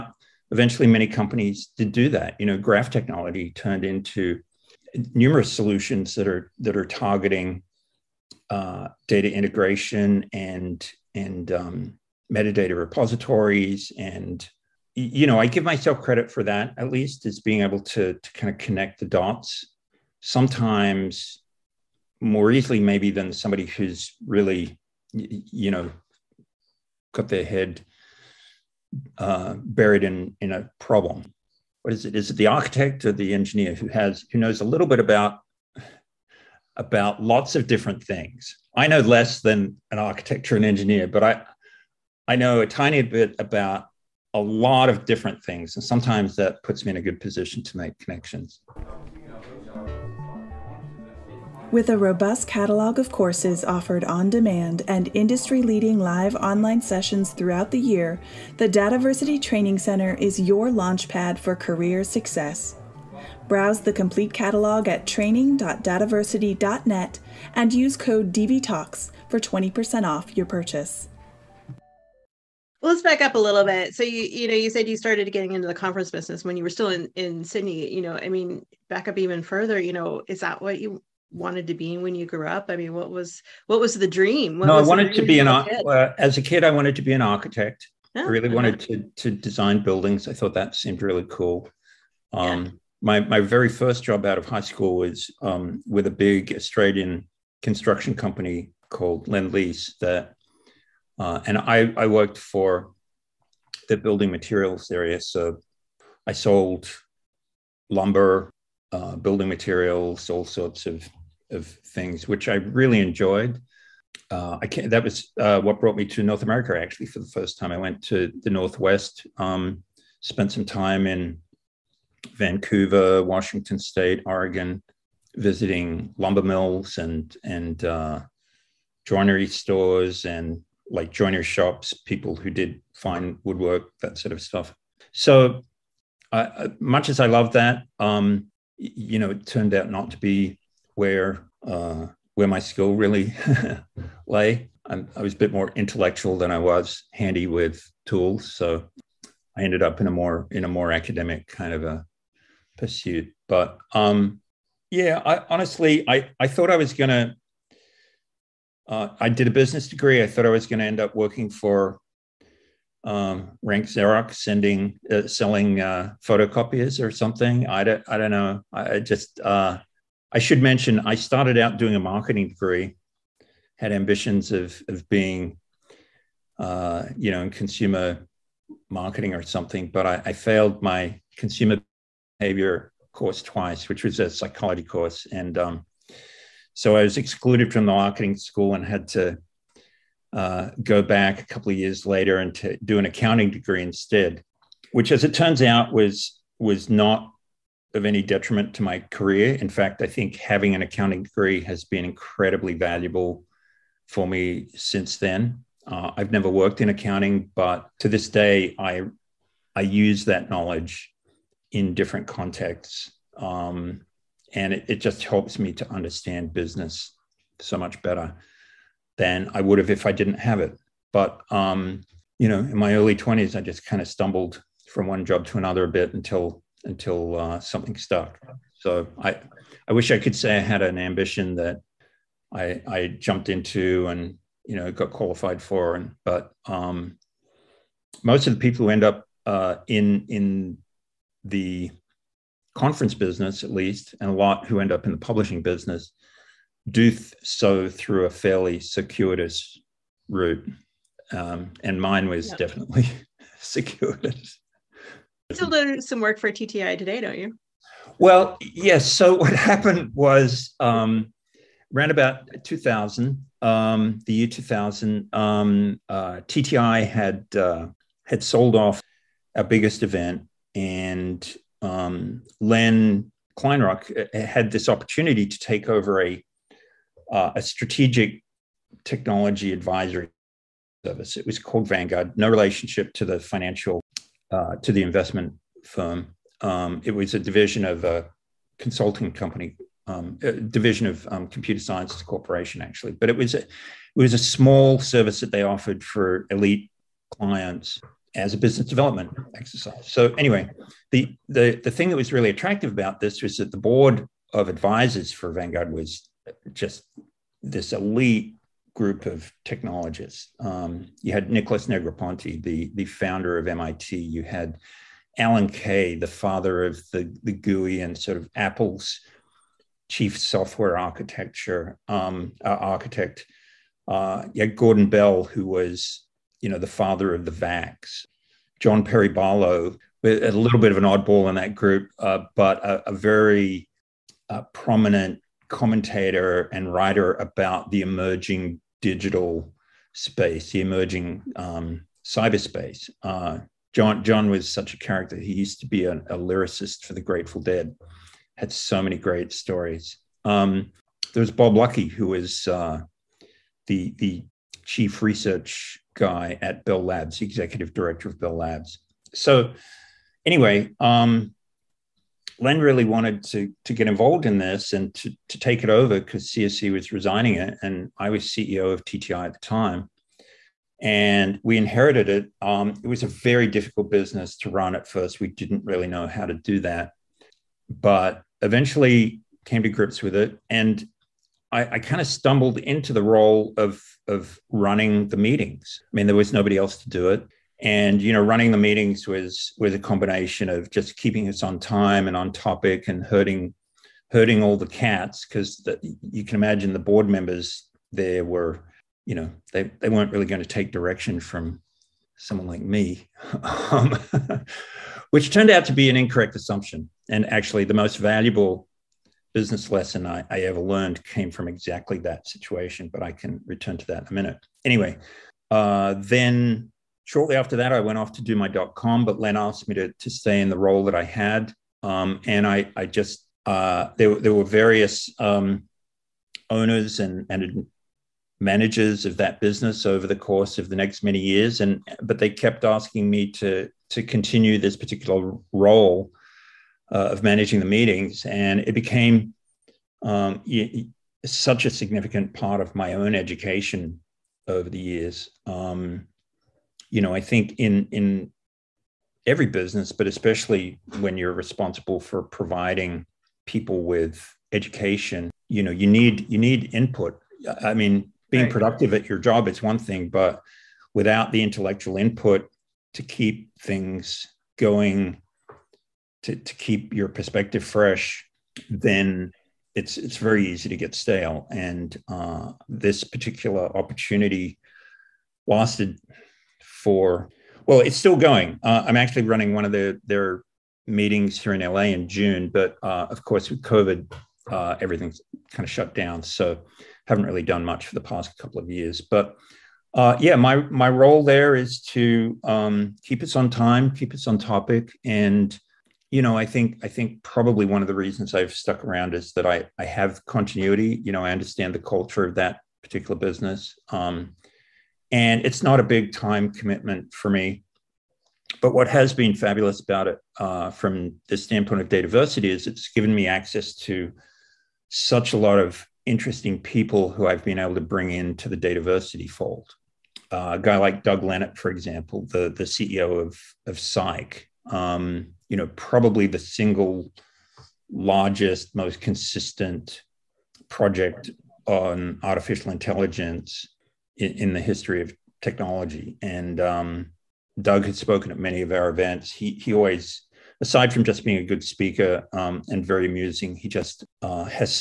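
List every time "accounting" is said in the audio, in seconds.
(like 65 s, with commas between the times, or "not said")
193 s, 200 s, 206 s.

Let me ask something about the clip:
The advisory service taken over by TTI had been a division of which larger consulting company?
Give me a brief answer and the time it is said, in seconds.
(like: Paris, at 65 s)
Computer Sciences Corporation, at 291 s.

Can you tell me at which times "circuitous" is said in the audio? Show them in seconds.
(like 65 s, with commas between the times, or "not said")
248 s, 253 s.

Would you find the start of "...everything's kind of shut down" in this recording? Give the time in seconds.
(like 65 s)
484 s.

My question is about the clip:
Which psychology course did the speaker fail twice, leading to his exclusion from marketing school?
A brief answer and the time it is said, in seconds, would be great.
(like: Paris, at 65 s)
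Consumer behavior, at 181 s.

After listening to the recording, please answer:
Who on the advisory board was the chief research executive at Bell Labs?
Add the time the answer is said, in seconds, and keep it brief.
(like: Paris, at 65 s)
Bob Lucky, at 351 s.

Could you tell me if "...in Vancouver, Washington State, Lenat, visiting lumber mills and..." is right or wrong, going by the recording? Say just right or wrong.
wrong.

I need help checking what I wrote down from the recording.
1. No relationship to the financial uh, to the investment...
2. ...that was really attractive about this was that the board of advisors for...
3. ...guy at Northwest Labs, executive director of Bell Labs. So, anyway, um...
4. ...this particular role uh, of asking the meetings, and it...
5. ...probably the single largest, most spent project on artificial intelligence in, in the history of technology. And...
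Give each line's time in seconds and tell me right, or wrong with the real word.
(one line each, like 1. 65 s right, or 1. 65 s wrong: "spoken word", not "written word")
1. 282 s right
2. 302 s right
3. 356 s wrong: "Bell", not "Northwest"
4. 434 s wrong: "managing", not "asking"
5. 525 s wrong: "consistent", not "spent".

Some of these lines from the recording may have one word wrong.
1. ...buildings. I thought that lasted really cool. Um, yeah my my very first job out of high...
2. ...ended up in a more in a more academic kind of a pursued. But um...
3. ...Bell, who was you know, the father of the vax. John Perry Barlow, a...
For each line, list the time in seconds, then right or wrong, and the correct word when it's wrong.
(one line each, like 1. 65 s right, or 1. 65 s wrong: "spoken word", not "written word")
1. 89 s wrong: "seemed", not "lasted"
2. 149 s right
3. 325 s right.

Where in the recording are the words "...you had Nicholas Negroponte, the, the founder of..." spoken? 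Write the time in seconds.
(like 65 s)
311 s.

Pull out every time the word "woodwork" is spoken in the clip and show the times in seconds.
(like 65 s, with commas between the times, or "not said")
133 s.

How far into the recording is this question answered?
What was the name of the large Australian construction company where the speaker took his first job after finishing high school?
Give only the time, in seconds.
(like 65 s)
99 s.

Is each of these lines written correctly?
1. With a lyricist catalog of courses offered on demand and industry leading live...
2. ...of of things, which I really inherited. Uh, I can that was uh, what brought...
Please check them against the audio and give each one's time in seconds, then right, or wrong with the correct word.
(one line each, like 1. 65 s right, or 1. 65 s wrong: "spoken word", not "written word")
1. 51 s wrong: "robust", not "lyricist"
2. 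110 s wrong: "enjoyed", not "inherited".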